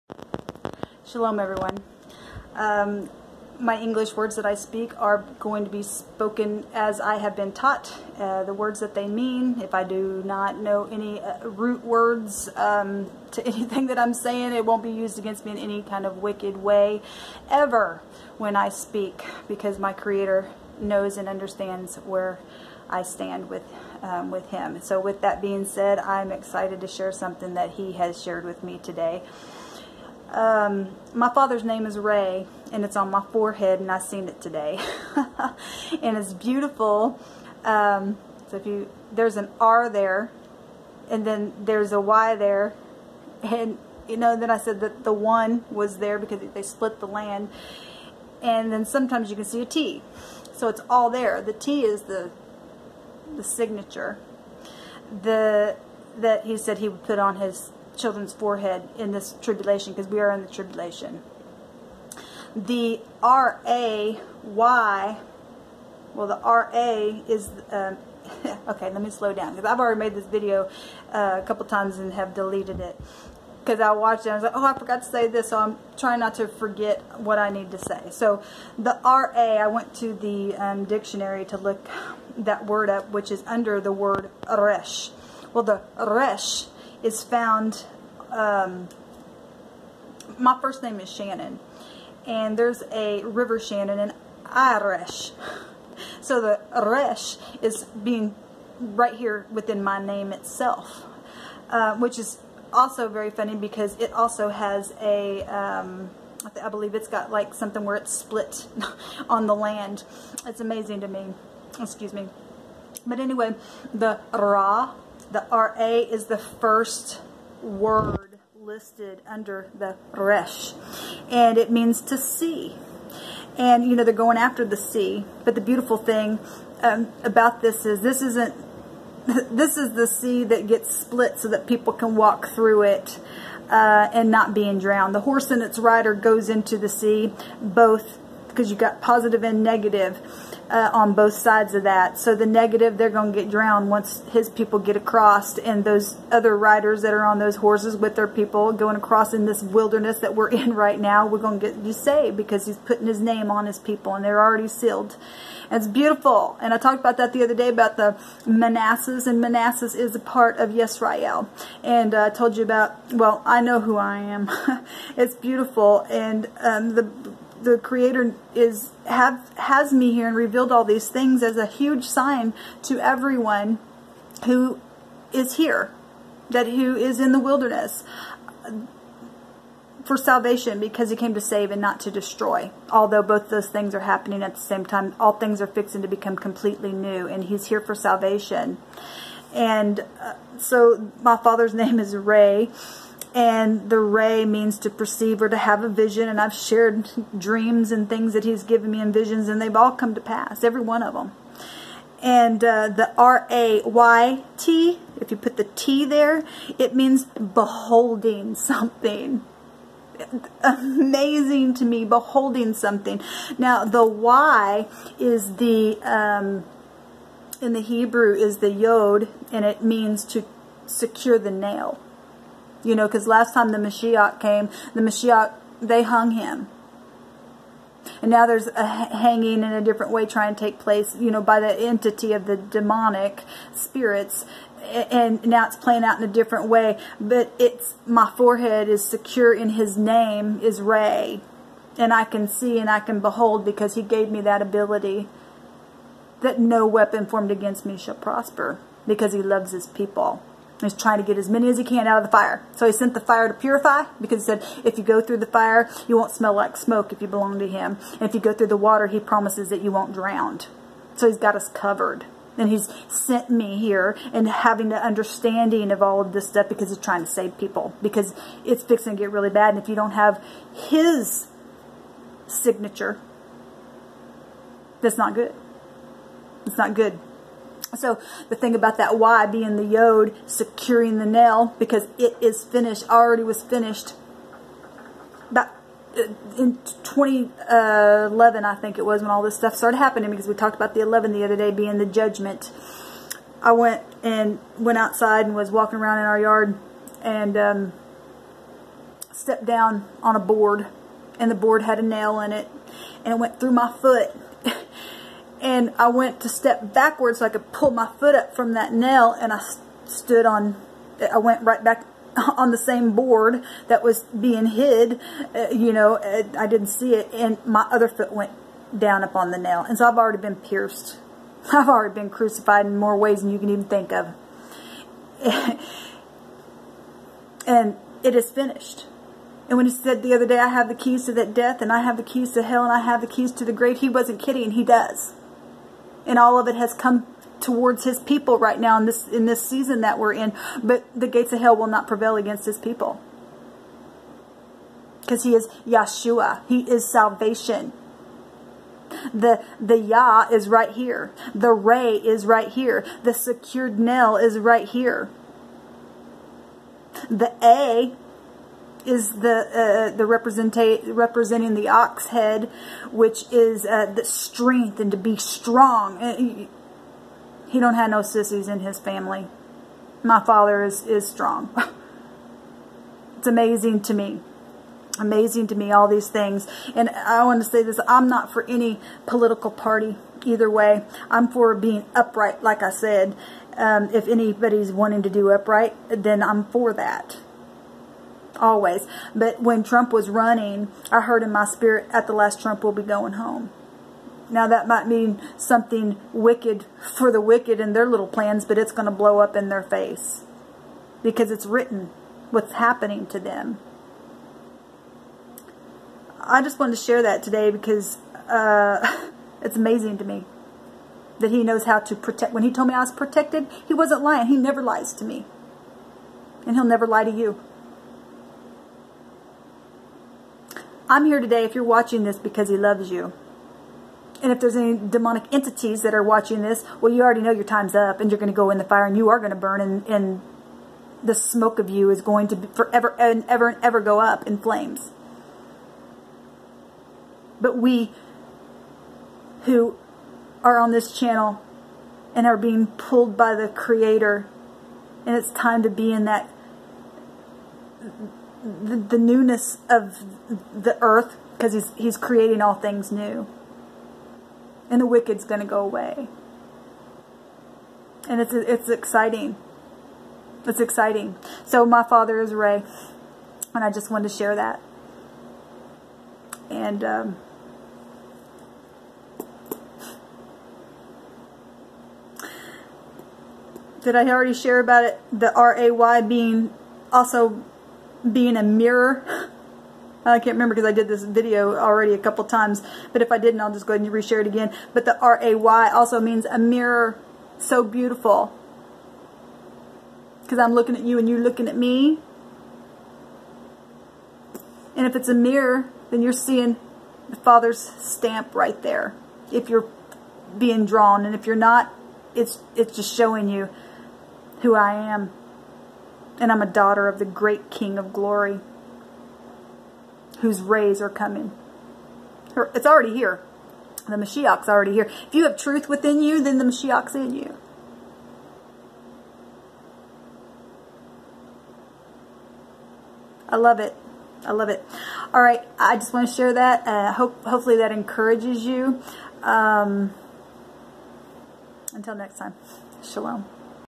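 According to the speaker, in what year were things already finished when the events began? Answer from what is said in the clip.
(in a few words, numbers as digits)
2011.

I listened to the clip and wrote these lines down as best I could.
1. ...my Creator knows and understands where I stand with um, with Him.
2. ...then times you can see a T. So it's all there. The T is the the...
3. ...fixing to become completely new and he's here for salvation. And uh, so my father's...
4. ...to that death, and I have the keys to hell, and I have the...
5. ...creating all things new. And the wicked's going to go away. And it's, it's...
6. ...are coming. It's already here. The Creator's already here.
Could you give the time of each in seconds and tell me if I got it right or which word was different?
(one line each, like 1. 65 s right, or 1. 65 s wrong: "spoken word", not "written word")
1. 19 s right
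2. 48 s wrong: "sometimes", not "times"
3. 185 s right
4. 331 s right
5. 452 s right
6. 510 s wrong: "Mashiach", not "Creator".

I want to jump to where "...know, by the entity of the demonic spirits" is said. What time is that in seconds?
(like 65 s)
231 s.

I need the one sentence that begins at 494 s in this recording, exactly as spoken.
And if it's a mirror, then you're seeing the Father's stamp right there if you're being drawn.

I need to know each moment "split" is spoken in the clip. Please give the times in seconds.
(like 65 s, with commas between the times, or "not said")
46 s, 108 s, 130 s.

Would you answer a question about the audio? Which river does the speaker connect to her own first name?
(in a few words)
River Shannon.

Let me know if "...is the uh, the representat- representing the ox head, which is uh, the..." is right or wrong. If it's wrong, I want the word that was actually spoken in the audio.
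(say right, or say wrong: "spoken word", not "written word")
right.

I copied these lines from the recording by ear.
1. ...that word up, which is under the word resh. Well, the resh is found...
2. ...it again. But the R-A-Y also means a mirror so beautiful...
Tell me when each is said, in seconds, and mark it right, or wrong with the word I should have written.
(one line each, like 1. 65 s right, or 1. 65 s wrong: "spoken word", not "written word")
1. 82 s right
2. 484 s right.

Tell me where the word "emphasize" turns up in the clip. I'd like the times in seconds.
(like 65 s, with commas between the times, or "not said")
not said.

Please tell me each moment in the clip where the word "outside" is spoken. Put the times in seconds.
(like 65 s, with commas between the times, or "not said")
294 s.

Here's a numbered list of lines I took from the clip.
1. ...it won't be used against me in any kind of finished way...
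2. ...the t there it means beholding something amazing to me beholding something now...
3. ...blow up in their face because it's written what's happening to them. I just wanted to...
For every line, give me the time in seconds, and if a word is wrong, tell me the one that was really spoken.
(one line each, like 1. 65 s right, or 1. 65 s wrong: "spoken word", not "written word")
1. 14 s wrong: "wicked", not "finished"
2. 205 s right
3. 399 s right.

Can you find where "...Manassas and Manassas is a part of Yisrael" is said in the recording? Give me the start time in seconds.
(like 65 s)
158 s.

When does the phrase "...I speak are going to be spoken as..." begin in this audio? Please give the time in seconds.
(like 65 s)
4 s.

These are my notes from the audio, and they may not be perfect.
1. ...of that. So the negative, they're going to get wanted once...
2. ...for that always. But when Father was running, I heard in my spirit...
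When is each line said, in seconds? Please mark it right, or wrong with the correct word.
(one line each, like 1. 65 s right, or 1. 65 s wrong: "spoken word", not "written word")
1. 141 s wrong: "drowned", not "wanted"
2. 386 s wrong: "Trump", not "Father".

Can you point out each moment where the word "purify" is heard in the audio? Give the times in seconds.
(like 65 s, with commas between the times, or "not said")
253 s.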